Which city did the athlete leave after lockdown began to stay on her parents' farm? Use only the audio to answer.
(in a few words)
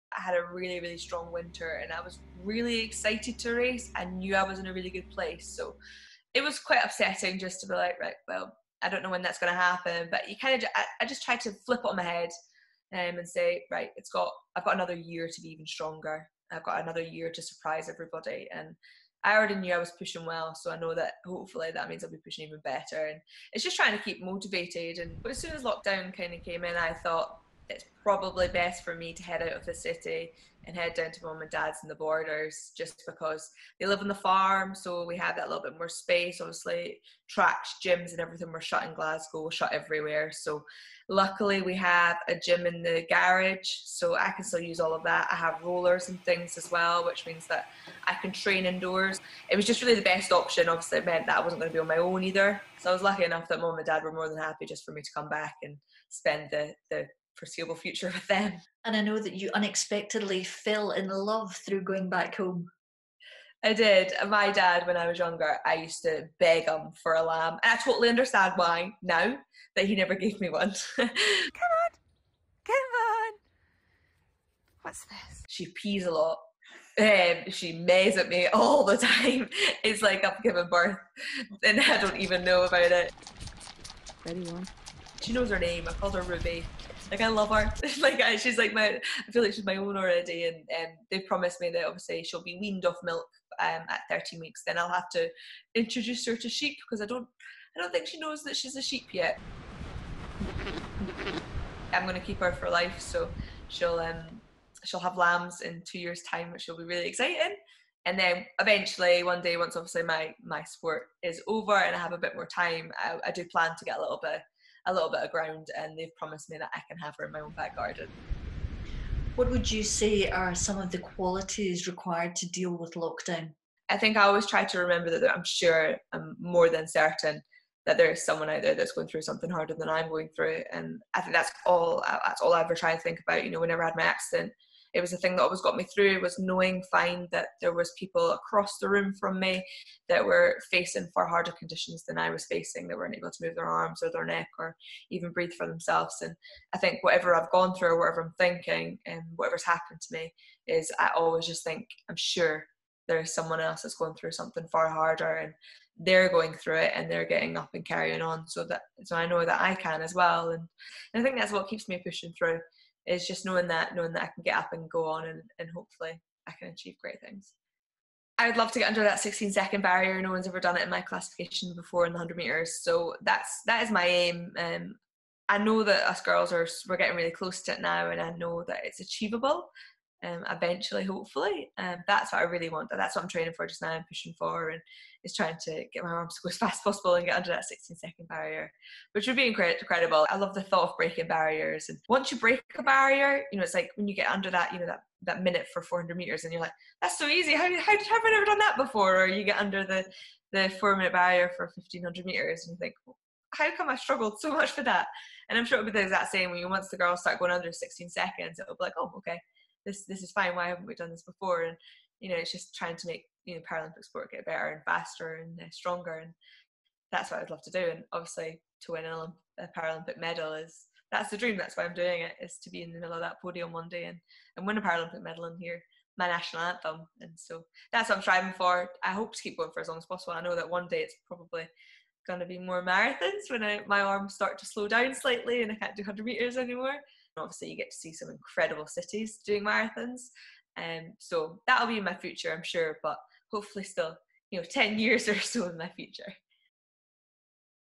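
Glasgow.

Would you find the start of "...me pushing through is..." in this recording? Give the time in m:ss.
2:41.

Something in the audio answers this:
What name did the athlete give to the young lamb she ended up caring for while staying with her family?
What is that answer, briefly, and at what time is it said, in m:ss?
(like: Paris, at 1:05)
Ruby, at 1:26.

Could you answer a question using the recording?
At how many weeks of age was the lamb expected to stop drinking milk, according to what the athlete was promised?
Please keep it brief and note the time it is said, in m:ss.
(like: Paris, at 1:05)
13 weeks, at 1:34.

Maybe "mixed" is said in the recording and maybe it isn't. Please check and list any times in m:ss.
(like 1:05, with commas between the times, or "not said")
not said.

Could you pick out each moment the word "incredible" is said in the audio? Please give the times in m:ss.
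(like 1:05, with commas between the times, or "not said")
3:09, 3:58.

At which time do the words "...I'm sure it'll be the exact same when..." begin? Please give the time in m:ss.
3:25.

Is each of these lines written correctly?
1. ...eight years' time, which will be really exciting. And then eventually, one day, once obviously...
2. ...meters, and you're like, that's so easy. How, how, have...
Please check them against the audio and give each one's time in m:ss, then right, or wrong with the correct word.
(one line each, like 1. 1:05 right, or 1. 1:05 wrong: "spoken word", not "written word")
1. 1:45 wrong: "two", not "eight"
2. 3:16 right.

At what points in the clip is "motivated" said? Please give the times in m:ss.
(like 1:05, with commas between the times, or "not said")
0:24.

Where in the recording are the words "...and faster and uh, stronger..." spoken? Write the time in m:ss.
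3:34.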